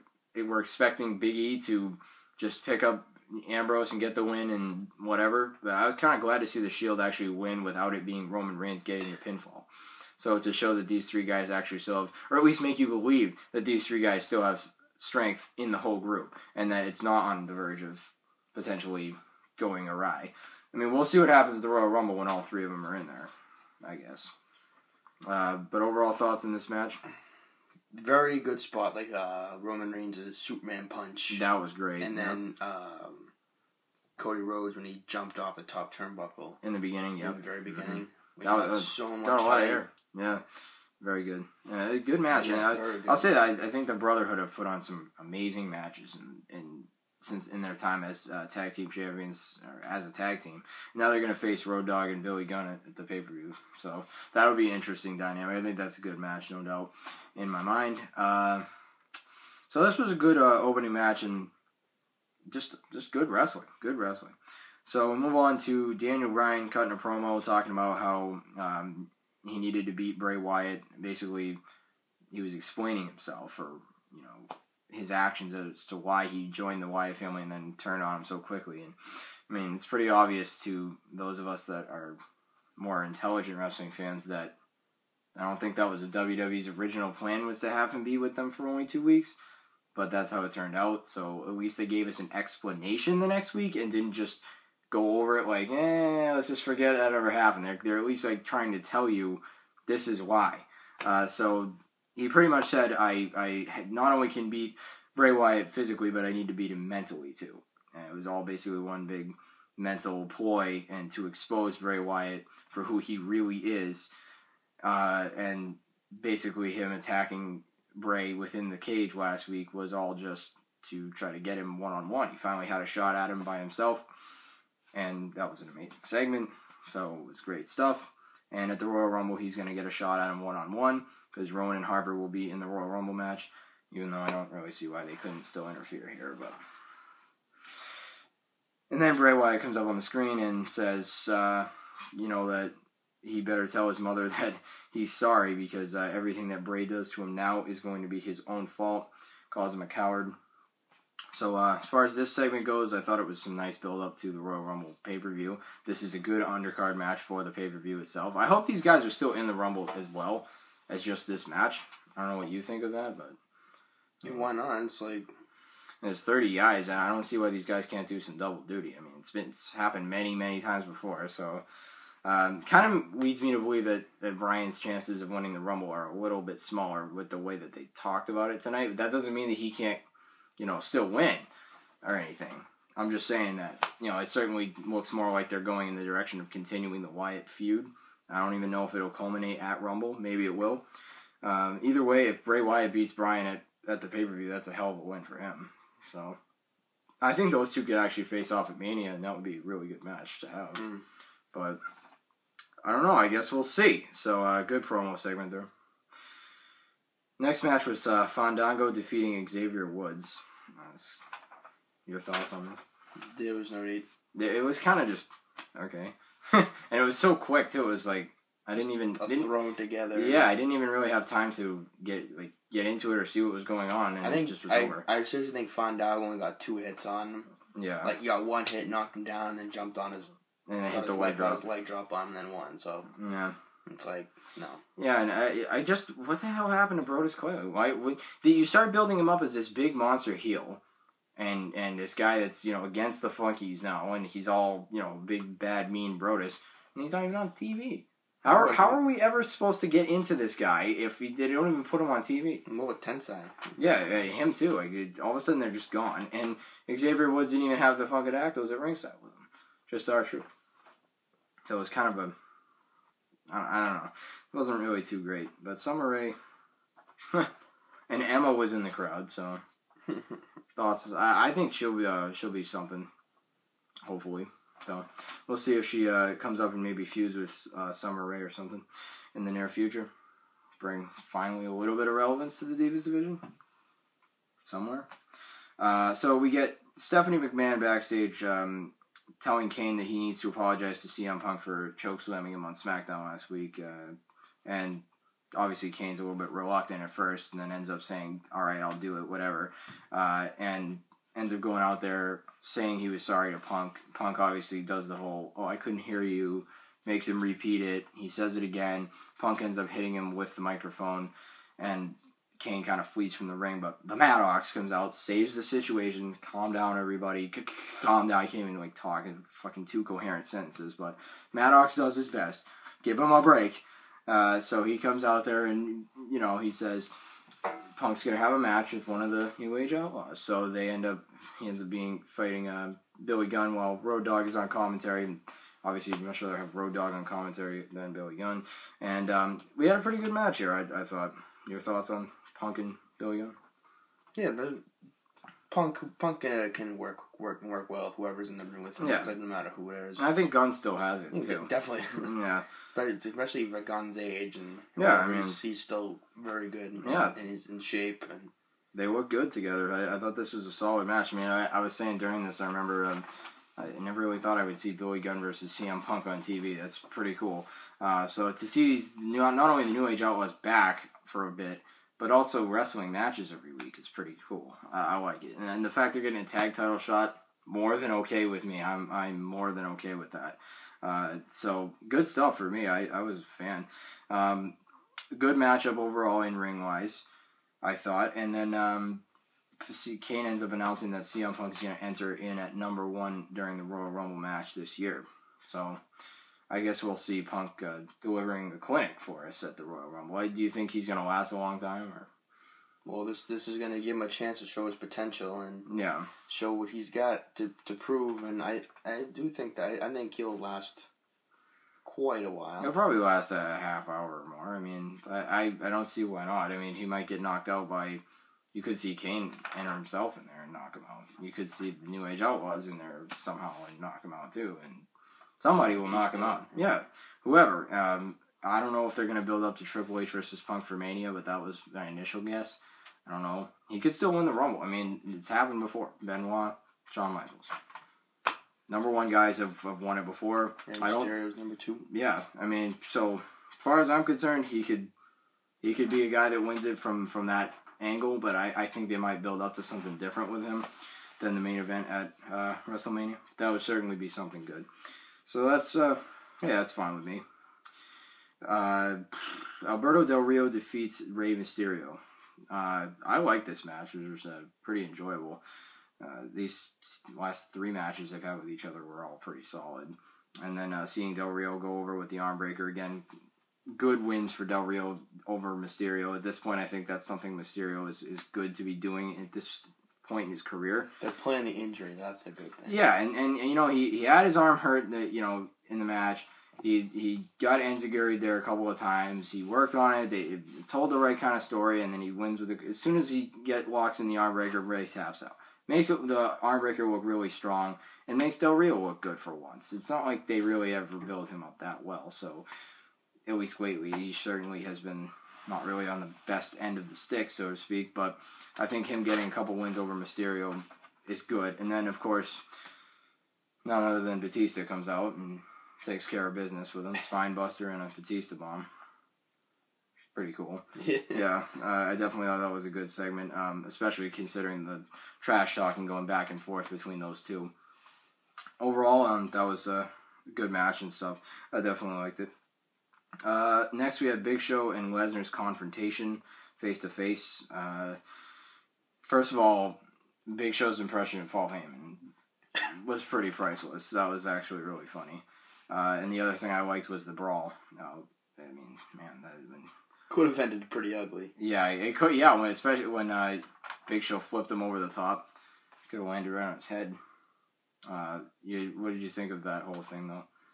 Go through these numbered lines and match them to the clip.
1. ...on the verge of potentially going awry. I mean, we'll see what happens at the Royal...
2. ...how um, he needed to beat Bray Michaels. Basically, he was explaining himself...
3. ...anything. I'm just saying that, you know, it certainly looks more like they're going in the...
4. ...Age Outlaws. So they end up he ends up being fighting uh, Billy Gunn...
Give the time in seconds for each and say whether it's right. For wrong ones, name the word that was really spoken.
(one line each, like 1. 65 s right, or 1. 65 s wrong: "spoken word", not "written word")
1. 17 s right
2. 67 s wrong: "Wyatt", not "Michaels"
3. 182 s right
4. 329 s right.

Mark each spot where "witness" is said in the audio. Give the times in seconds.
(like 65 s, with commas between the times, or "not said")
not said.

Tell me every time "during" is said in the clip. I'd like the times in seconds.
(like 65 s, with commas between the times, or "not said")
362 s, 393 s.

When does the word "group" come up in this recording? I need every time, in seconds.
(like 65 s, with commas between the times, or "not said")
15 s.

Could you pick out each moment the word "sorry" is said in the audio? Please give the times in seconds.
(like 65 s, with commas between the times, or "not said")
145 s, 303 s.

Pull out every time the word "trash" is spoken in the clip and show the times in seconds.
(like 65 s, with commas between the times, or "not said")
525 s.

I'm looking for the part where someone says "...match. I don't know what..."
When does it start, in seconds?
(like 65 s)
161 s.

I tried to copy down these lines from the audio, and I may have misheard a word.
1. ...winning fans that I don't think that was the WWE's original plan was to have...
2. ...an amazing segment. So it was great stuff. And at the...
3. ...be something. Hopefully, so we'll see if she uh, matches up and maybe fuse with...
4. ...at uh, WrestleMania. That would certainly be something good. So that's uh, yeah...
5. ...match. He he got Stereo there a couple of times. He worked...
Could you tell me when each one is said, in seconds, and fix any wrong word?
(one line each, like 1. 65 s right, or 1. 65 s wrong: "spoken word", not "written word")
1. 83 s wrong: "wrestling", not "winning"
2. 125 s right
3. 272 s wrong: "comes", not "matches"
4. 452 s right
5. 486 s wrong: "Enziguri", not "Stereo".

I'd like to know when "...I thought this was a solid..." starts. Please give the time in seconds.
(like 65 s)
360 s.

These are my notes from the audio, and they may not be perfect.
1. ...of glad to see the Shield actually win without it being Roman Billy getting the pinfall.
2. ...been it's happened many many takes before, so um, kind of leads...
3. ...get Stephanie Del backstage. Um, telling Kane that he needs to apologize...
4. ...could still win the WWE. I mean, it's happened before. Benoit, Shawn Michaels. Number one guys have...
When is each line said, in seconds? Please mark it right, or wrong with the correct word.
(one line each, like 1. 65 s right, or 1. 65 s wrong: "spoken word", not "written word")
1. 6 s wrong: "Reigns", not "Billy"
2. 169 s wrong: "times", not "takes"
3. 286 s wrong: "McMahon", not "Del"
4. 433 s wrong: "Rumble", not "WWE".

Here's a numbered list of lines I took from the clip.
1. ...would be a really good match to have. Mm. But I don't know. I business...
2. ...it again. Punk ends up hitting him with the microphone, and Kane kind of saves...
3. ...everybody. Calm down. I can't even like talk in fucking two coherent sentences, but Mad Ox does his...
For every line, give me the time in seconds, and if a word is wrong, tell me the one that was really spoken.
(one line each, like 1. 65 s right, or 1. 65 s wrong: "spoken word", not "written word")
1. 199 s wrong: "guess", not "business"
2. 308 s wrong: "flees", not "saves"
3. 316 s right.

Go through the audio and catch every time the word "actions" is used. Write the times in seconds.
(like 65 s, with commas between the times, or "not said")
75 s.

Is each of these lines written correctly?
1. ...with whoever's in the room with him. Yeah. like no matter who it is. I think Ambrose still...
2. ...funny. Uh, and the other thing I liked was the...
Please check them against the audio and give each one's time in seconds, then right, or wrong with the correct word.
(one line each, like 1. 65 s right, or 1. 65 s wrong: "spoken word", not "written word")
1. 348 s wrong: "Gunn", not "Ambrose"
2. 545 s right.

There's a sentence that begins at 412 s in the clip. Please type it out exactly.
It'll probably last a half hour or more.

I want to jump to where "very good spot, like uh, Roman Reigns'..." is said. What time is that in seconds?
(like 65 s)
27 s.